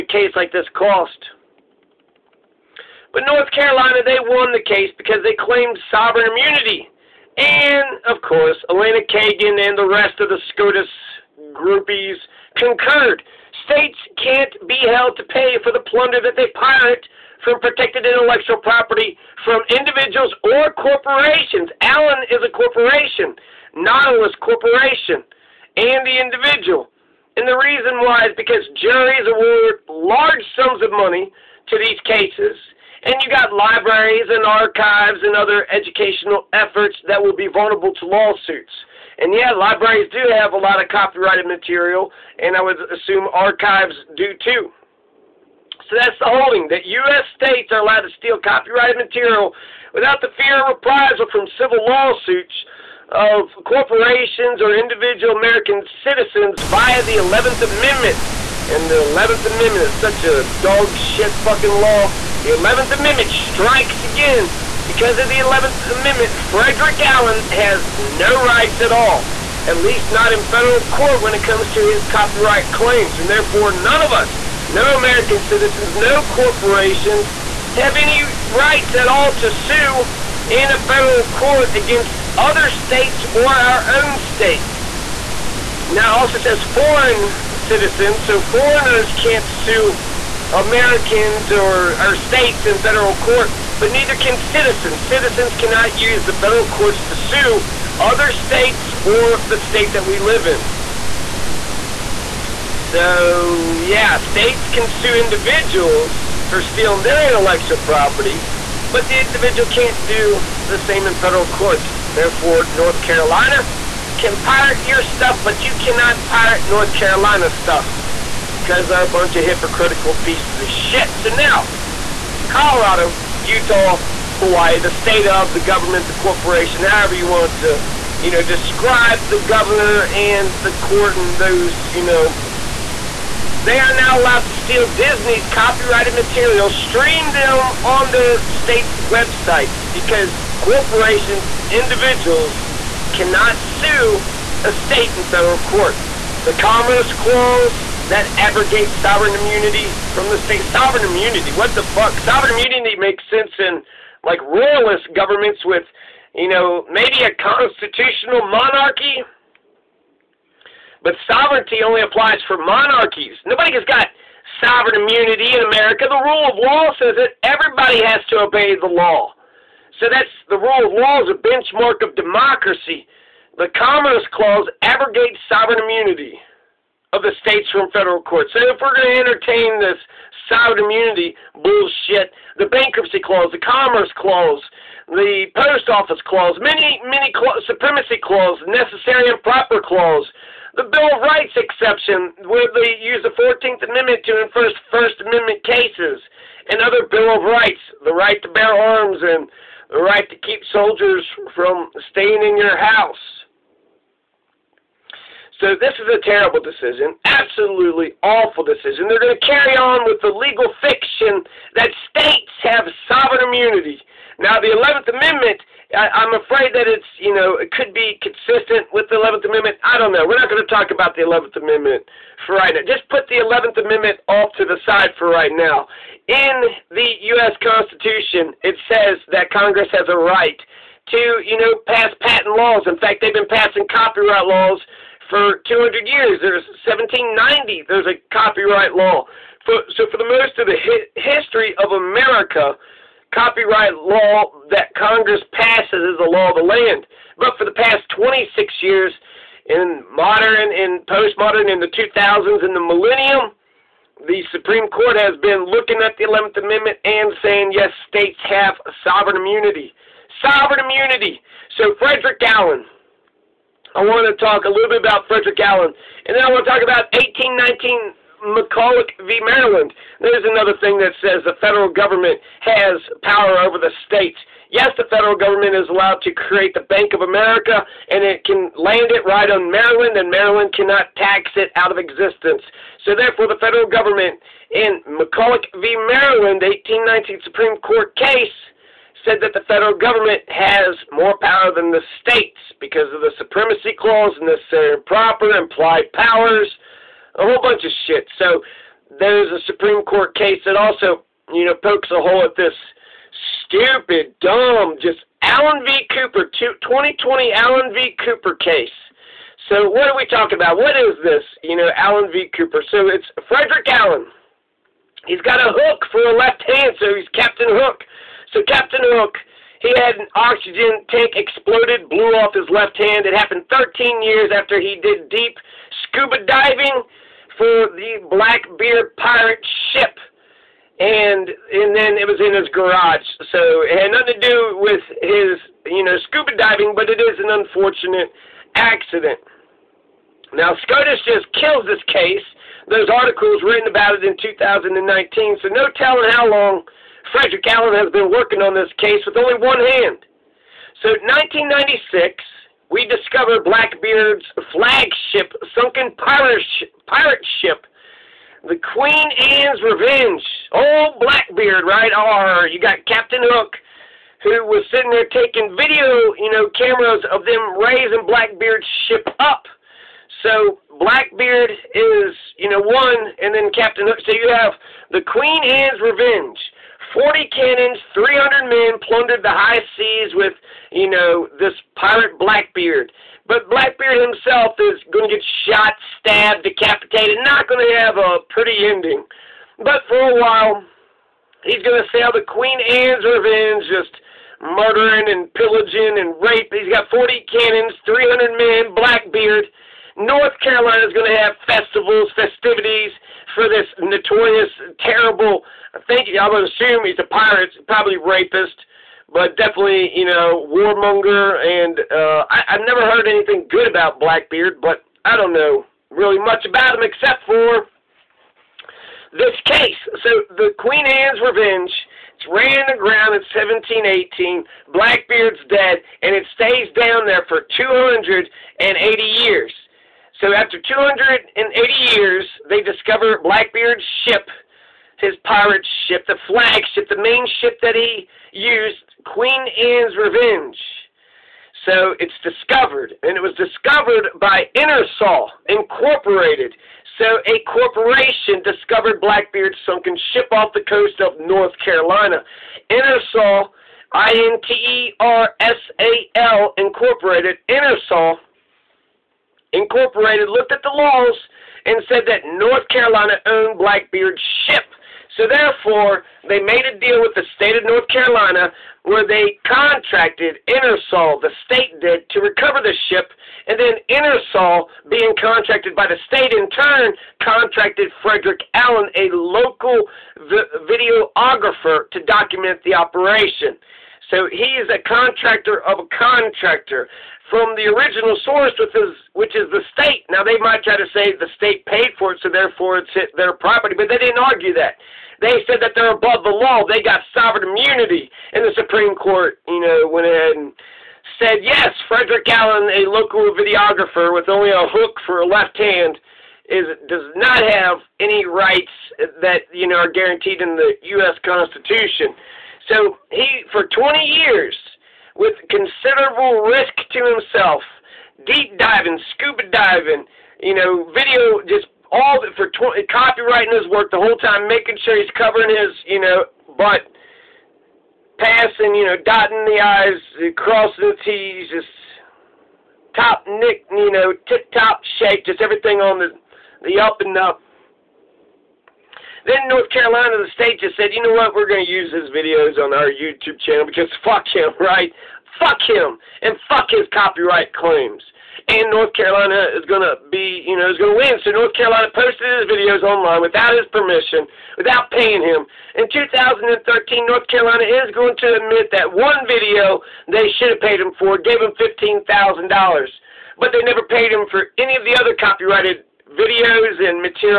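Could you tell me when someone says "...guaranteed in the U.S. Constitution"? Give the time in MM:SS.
08:30.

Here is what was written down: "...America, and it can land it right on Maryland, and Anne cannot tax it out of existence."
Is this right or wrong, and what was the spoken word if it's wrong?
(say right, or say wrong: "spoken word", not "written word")
wrong: "Maryland", not "Anne".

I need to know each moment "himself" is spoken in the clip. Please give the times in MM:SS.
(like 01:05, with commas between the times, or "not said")
06:24, 08:37.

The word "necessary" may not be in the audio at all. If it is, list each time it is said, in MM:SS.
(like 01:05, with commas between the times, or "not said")
03:08, 04:54.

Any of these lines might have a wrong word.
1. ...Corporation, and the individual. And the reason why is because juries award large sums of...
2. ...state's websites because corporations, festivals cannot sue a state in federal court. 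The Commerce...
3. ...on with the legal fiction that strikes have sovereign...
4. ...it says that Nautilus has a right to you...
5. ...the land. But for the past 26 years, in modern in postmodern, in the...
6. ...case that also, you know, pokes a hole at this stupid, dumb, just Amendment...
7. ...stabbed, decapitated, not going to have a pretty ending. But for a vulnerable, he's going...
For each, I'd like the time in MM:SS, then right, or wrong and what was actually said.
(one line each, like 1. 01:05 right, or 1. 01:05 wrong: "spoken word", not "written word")
1. 00:24 right
2. 02:18 wrong: "individuals", not "festivals"
3. 03:29 wrong: "states", not "strikes"
4. 03:48 wrong: "Congress", not "Nautilus"
5. 04:06 right
6. 05:00 wrong: "Allen", not "Amendment"
7. 06:26 wrong: "while", not "vulnerable".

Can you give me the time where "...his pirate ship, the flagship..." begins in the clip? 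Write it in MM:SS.
07:15.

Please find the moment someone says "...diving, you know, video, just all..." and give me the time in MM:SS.
08:39.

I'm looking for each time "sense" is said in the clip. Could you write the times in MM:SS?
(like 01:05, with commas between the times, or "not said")
02:33.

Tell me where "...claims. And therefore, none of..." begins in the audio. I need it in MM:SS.
01:12.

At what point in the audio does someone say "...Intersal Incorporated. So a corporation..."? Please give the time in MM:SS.
07:24.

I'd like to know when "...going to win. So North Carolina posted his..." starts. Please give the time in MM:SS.
09:10.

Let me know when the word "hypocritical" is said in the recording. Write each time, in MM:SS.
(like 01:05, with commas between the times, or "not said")
01:59.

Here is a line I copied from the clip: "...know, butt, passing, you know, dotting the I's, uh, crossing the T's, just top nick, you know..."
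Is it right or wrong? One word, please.
right.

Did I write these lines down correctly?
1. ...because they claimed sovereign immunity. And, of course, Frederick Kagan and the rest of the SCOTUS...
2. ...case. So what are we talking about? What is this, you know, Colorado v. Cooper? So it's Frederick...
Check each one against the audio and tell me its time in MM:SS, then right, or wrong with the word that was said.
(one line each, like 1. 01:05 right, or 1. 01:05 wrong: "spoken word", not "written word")
1. 00:04 wrong: "Elena", not "Frederick"
2. 05:08 wrong: "Allen", not "Colorado".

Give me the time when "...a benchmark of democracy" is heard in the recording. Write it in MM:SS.
02:51.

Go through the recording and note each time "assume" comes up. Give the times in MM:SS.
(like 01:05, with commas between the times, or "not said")
00:42, 06:46.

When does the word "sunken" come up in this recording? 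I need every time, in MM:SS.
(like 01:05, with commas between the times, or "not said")
05:55, 07:29.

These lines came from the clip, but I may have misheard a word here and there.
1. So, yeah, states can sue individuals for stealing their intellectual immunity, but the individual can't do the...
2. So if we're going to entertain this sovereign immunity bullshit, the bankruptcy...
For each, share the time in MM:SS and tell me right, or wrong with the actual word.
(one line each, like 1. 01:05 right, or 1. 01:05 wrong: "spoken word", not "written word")
1. 01:42 wrong: "property", not "immunity"
2. 02:58 right.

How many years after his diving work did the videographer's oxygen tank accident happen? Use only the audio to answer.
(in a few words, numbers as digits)
13.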